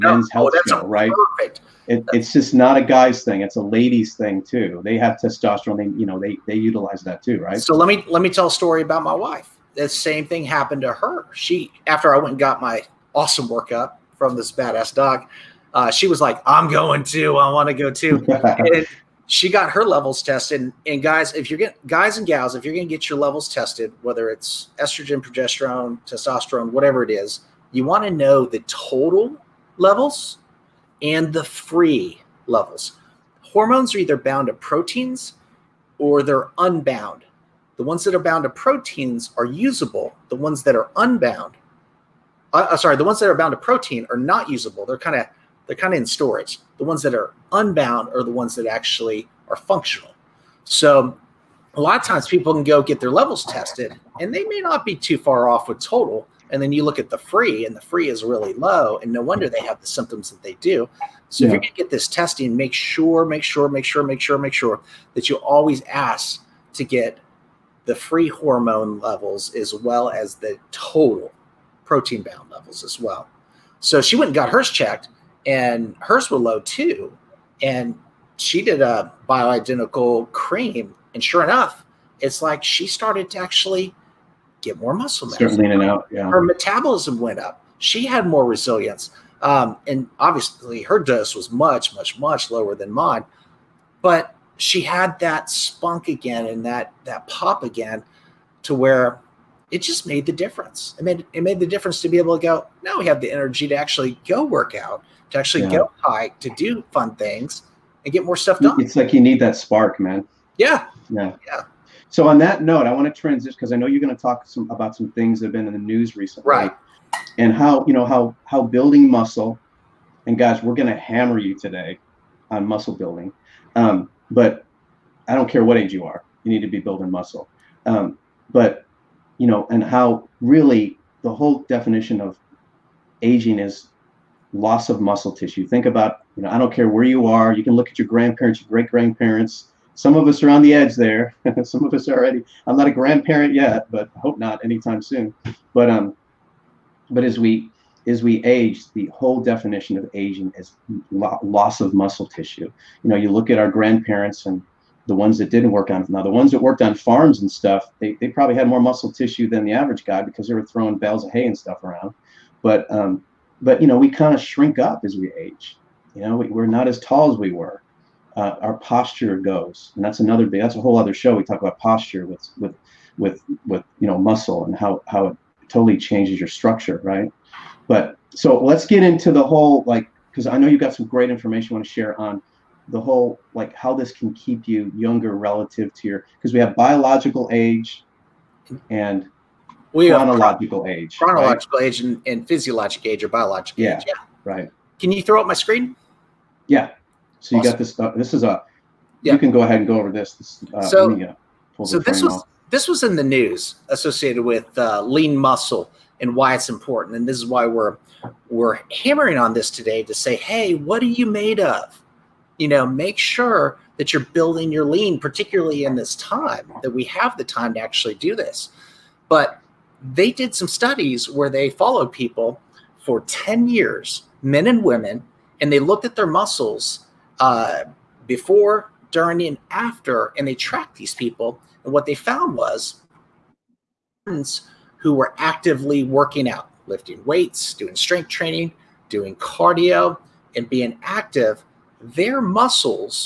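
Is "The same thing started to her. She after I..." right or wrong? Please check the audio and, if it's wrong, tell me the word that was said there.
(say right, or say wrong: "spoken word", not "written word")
wrong: "happened", not "started".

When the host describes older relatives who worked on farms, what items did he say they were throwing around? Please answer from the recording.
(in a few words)
bales of hay.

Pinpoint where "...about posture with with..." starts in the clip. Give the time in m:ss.
2:51.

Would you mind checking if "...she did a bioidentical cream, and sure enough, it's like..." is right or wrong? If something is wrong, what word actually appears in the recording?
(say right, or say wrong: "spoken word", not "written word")
right.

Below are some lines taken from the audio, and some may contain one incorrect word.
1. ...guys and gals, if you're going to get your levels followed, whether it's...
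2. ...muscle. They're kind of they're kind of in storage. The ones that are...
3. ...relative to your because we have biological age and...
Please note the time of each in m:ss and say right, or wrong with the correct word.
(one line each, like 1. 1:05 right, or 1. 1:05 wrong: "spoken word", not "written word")
1. 0:21 wrong: "tested", not "followed"
2. 0:44 wrong: "usable", not "muscle"
3. 3:05 right.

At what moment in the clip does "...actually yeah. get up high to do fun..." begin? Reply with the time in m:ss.
1:45.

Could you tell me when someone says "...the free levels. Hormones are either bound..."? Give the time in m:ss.
0:31.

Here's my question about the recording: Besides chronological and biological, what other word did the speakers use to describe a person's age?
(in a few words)
physiologic.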